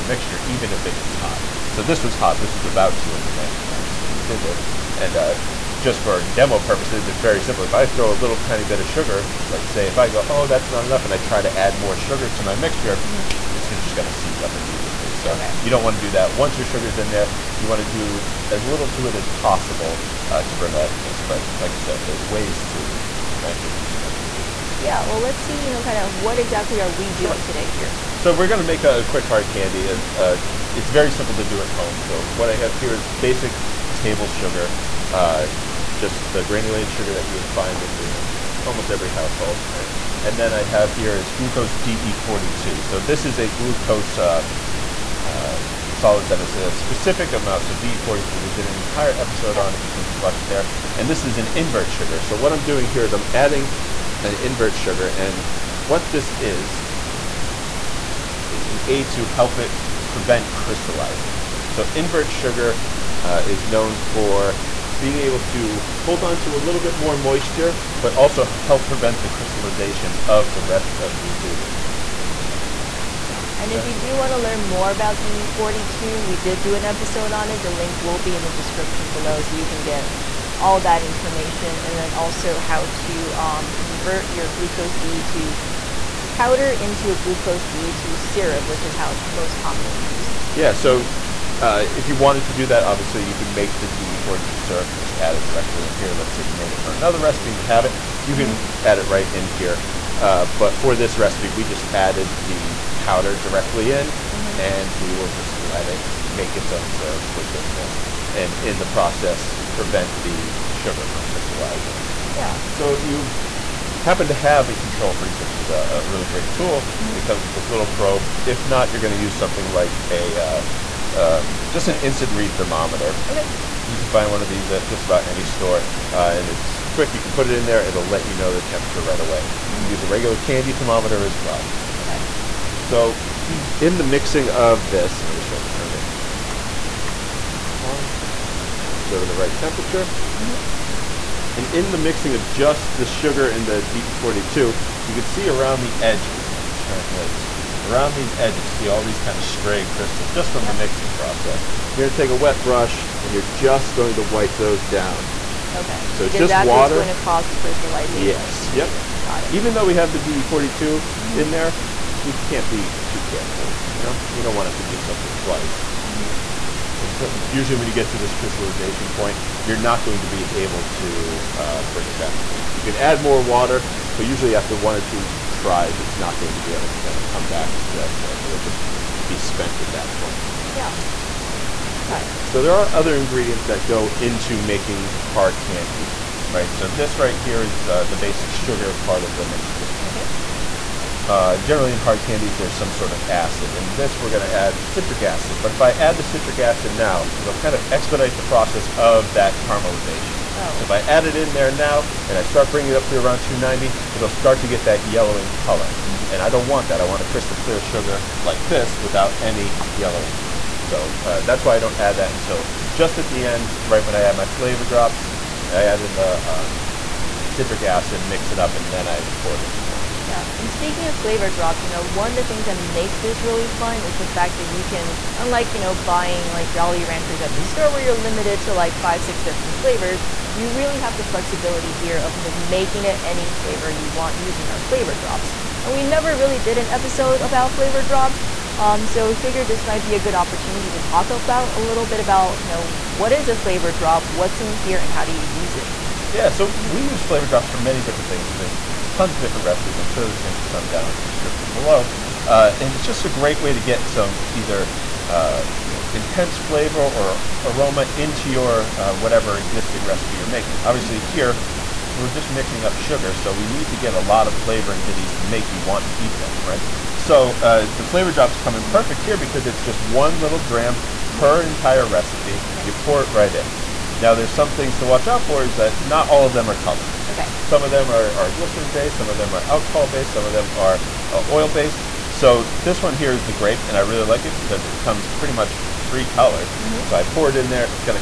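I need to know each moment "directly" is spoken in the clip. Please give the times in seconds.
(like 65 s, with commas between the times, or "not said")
95 s, 103 s.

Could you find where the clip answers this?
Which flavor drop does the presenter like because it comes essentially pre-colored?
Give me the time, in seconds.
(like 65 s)
283 s.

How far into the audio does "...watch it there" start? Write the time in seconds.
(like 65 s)
50 s.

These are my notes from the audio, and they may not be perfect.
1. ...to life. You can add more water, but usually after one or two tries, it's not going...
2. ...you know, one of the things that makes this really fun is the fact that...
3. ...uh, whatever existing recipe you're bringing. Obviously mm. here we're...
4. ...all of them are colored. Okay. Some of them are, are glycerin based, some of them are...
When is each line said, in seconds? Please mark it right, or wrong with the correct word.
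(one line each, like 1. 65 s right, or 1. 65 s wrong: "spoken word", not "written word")
1. 172 s right
2. 221 s right
3. 258 s wrong: "making", not "bringing"
4. 276 s right.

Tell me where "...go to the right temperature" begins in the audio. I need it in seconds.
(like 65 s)
139 s.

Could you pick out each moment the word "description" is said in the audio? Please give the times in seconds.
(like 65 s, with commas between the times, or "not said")
78 s, 251 s.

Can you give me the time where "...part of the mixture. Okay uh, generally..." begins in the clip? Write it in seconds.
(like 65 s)
188 s.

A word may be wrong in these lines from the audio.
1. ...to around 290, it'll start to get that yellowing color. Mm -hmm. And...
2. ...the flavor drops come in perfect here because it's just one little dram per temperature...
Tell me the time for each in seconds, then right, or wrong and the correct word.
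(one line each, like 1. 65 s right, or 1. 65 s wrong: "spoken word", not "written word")
1. 203 s right
2. 267 s wrong: "entire", not "temperature".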